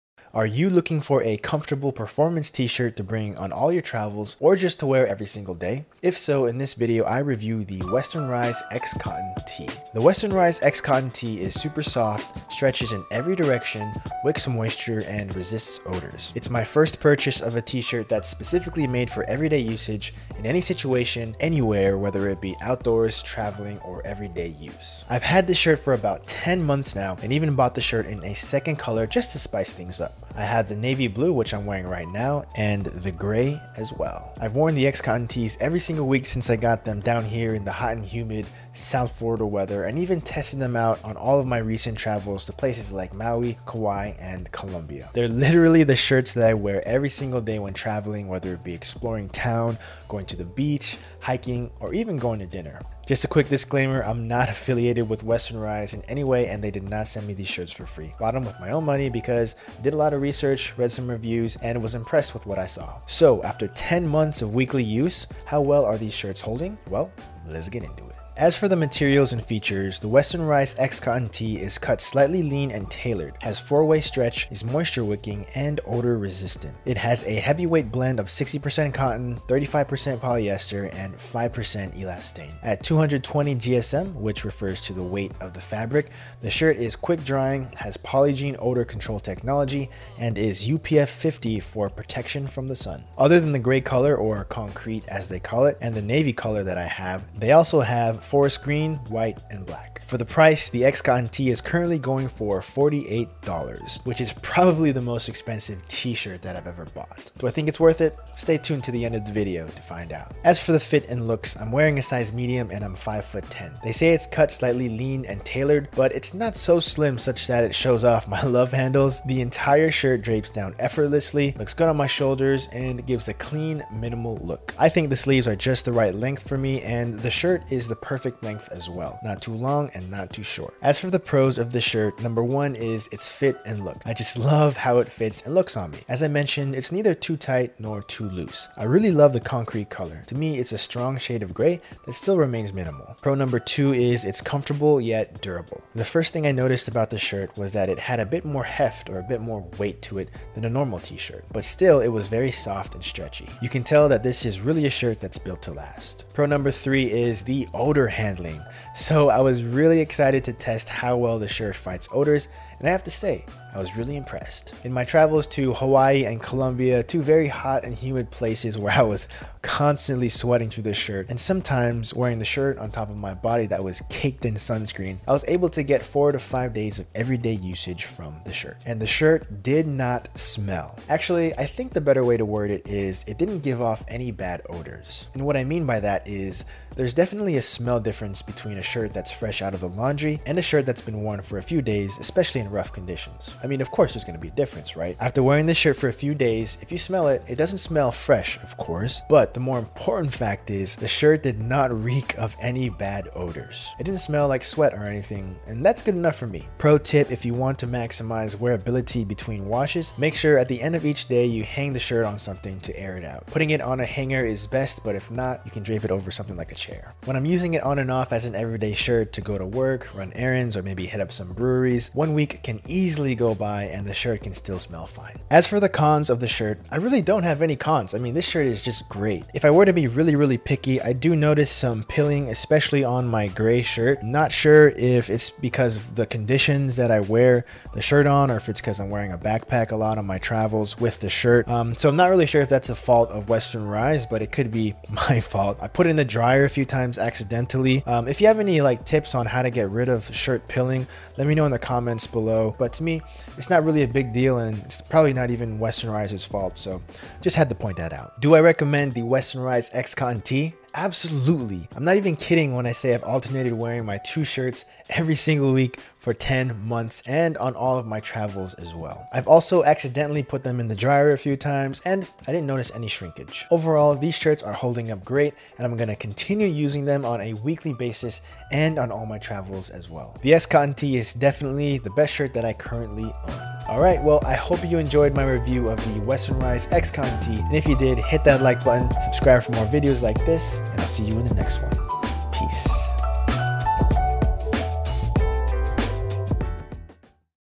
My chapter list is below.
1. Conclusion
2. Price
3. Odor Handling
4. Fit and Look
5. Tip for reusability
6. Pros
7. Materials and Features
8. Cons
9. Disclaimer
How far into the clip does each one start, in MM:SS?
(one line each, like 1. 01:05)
1. 04:18
2. 01:40
3. 02:37
4. 01:50
5. 03:27
6. 02:11
7. 01:08
8. 03:45
9. 00:53.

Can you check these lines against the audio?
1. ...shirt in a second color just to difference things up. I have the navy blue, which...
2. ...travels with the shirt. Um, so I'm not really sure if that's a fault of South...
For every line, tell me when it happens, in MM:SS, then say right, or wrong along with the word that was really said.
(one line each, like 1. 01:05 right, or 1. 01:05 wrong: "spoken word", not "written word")
1. 00:27 wrong: "spice", not "difference"
2. 04:00 wrong: "Western", not "South".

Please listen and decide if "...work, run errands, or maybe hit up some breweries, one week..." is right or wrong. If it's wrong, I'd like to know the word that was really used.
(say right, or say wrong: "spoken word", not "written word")
right.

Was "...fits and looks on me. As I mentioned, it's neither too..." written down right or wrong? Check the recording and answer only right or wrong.
right.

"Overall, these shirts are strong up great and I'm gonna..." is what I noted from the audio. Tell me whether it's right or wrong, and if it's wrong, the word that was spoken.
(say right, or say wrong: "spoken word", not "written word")
wrong: "holding", not "strong".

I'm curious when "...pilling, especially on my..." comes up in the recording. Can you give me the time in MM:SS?
03:52.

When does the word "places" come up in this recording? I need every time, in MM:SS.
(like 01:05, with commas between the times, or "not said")
00:42, 02:48.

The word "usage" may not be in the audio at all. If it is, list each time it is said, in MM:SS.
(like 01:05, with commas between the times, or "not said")
00:19, 02:57.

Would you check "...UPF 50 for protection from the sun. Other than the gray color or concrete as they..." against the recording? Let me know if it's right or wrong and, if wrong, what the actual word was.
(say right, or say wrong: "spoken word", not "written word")
right.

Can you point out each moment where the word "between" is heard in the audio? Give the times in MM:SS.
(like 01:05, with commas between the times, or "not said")
03:08, 03:29.